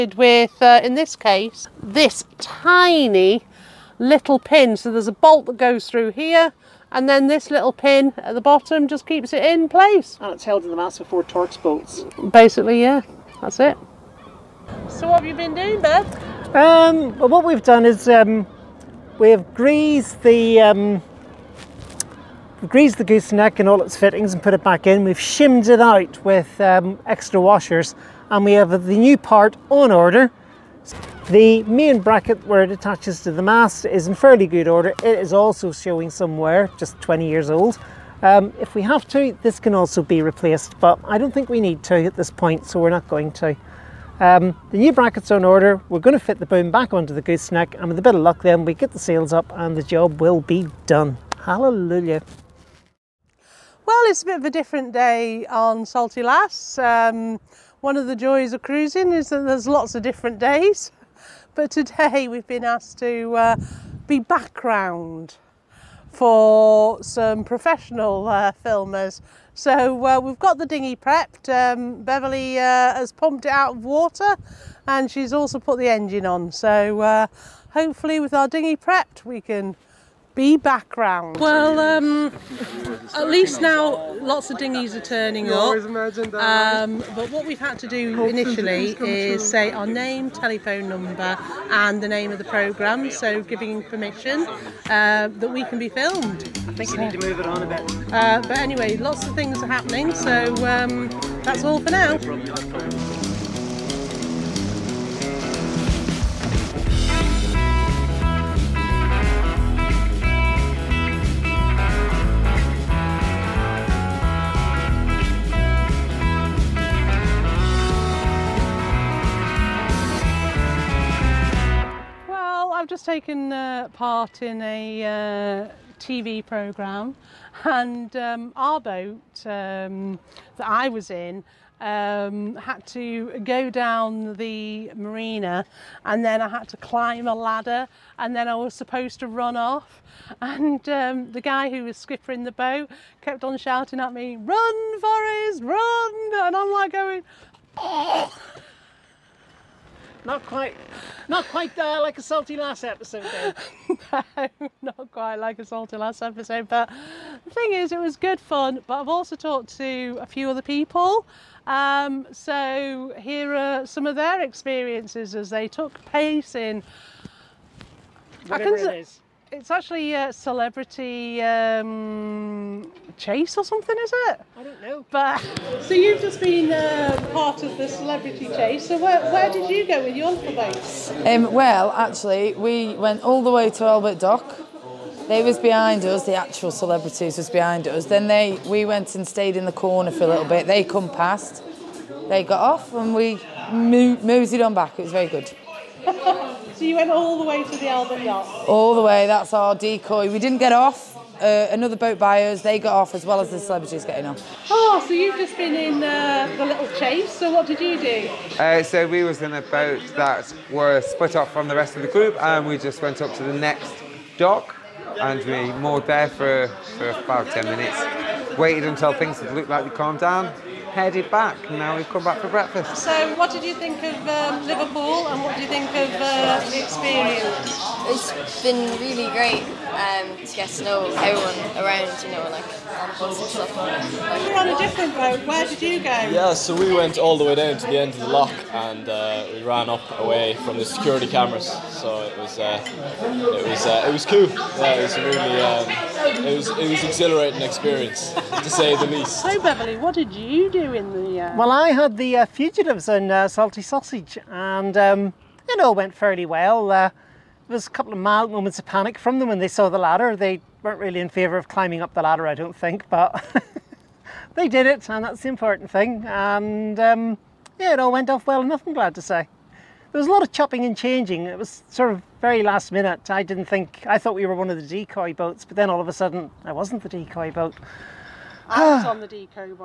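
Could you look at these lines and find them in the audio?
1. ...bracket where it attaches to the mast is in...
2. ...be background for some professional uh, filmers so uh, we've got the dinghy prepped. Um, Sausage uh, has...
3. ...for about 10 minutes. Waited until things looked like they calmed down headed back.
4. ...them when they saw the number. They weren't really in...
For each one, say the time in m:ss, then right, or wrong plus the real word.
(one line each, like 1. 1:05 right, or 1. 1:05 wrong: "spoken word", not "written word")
1. 0:31 right
2. 1:04 wrong: "Beverly", not "Sausage"
3. 3:36 right
4. 4:19 wrong: "ladder", not "number".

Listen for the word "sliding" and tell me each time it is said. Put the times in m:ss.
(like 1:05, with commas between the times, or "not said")
not said.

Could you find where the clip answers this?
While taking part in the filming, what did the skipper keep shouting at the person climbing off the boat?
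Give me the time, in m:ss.
2:24.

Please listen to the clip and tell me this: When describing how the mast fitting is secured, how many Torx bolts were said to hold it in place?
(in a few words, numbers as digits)
4.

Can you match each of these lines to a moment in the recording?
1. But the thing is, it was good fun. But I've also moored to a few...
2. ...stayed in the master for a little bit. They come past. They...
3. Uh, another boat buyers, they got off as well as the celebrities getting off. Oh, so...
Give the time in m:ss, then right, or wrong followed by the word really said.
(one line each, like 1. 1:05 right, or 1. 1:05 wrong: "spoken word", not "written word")
1. 2:36 wrong: "talked", not "moored"
2. 3:09 wrong: "corner", not "master"
3. 3:21 right.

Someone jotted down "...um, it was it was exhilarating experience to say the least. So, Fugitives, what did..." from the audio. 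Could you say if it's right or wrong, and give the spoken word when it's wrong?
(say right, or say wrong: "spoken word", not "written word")
wrong: "Beverly", not "Fugitives".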